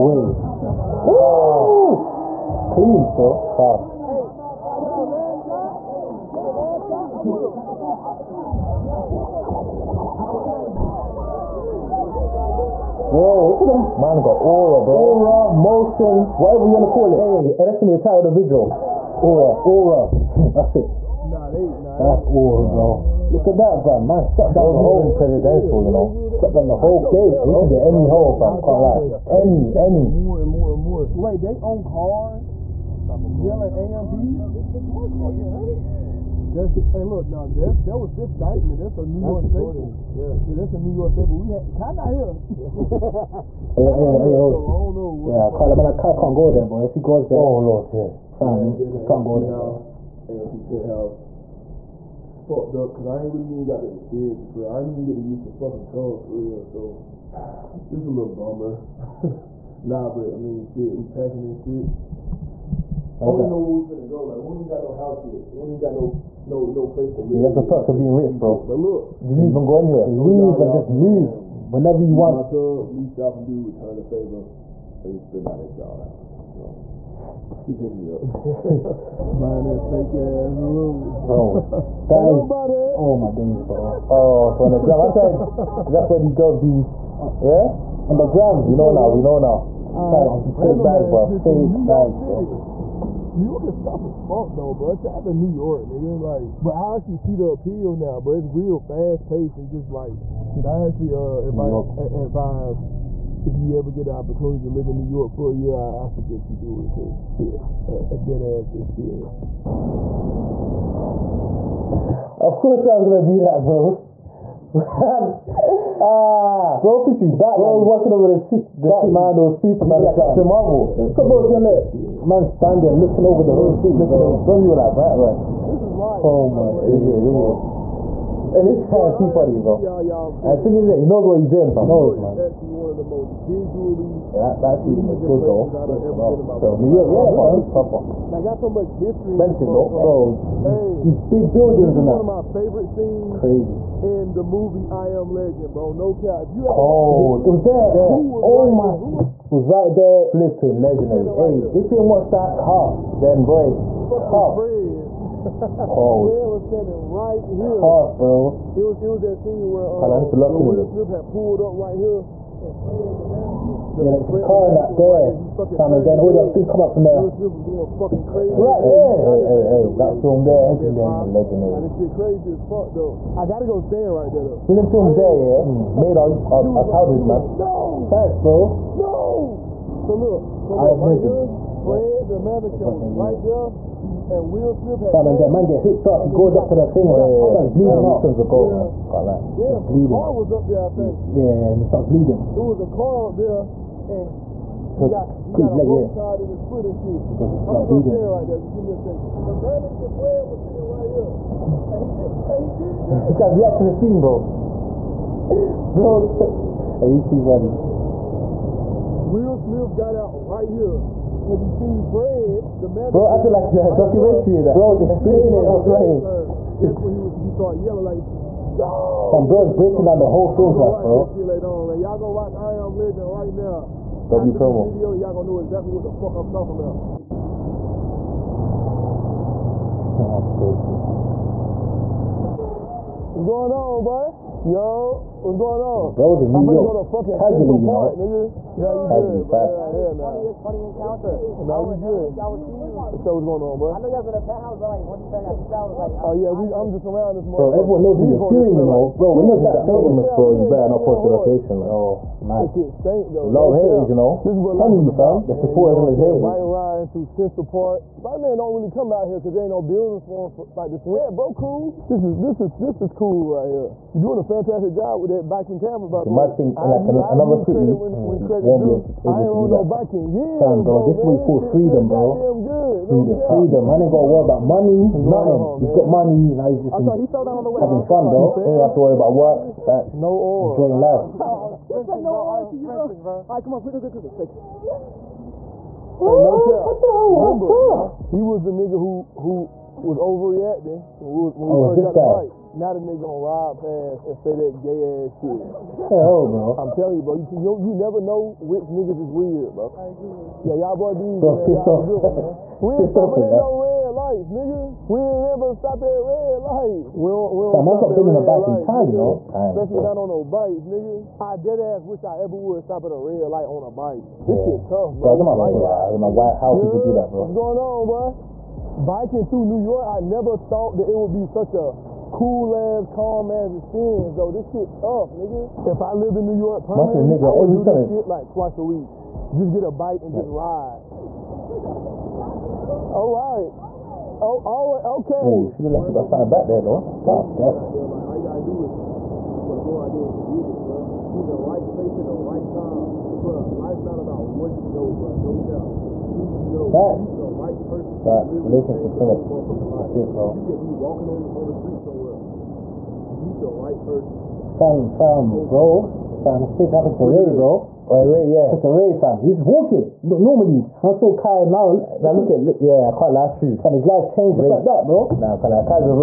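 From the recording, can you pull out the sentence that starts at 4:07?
Bro, everyone knows what you're doing, you know.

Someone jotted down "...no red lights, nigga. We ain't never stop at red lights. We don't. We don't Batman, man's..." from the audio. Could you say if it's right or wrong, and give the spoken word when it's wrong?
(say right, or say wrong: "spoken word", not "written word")
wrong: "Fam", not "Batman".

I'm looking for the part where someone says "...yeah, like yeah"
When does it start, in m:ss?
5:15.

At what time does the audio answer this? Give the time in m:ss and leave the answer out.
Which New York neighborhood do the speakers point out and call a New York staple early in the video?
0:38.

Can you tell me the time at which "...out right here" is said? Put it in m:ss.
3:30.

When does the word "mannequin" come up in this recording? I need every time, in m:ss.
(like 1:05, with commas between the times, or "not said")
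2:43, 3:02, 3:19.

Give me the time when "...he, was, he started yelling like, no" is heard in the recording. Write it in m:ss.
3:36.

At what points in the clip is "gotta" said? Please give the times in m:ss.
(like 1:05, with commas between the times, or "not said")
2:53, 5:38.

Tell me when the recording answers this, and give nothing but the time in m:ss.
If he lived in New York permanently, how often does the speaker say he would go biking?
5:28.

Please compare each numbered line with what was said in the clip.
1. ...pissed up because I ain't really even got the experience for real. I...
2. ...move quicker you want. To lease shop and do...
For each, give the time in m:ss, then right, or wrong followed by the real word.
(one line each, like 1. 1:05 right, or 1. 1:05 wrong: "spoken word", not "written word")
1. 0:52 wrong: "fucked", not "pissed"
2. 1:10 wrong: "whenever", not "quicker".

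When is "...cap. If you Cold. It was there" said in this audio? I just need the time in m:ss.
2:26.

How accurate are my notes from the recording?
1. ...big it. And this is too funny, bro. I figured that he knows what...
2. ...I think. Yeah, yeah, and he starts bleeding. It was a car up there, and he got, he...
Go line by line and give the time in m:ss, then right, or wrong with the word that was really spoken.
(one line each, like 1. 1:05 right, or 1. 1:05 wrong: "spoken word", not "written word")
1. 2:07 right
2. 3:10 right.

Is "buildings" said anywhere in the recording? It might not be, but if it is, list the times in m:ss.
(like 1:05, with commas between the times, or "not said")
2:21, 4:19.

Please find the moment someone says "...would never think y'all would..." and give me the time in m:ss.
4:01.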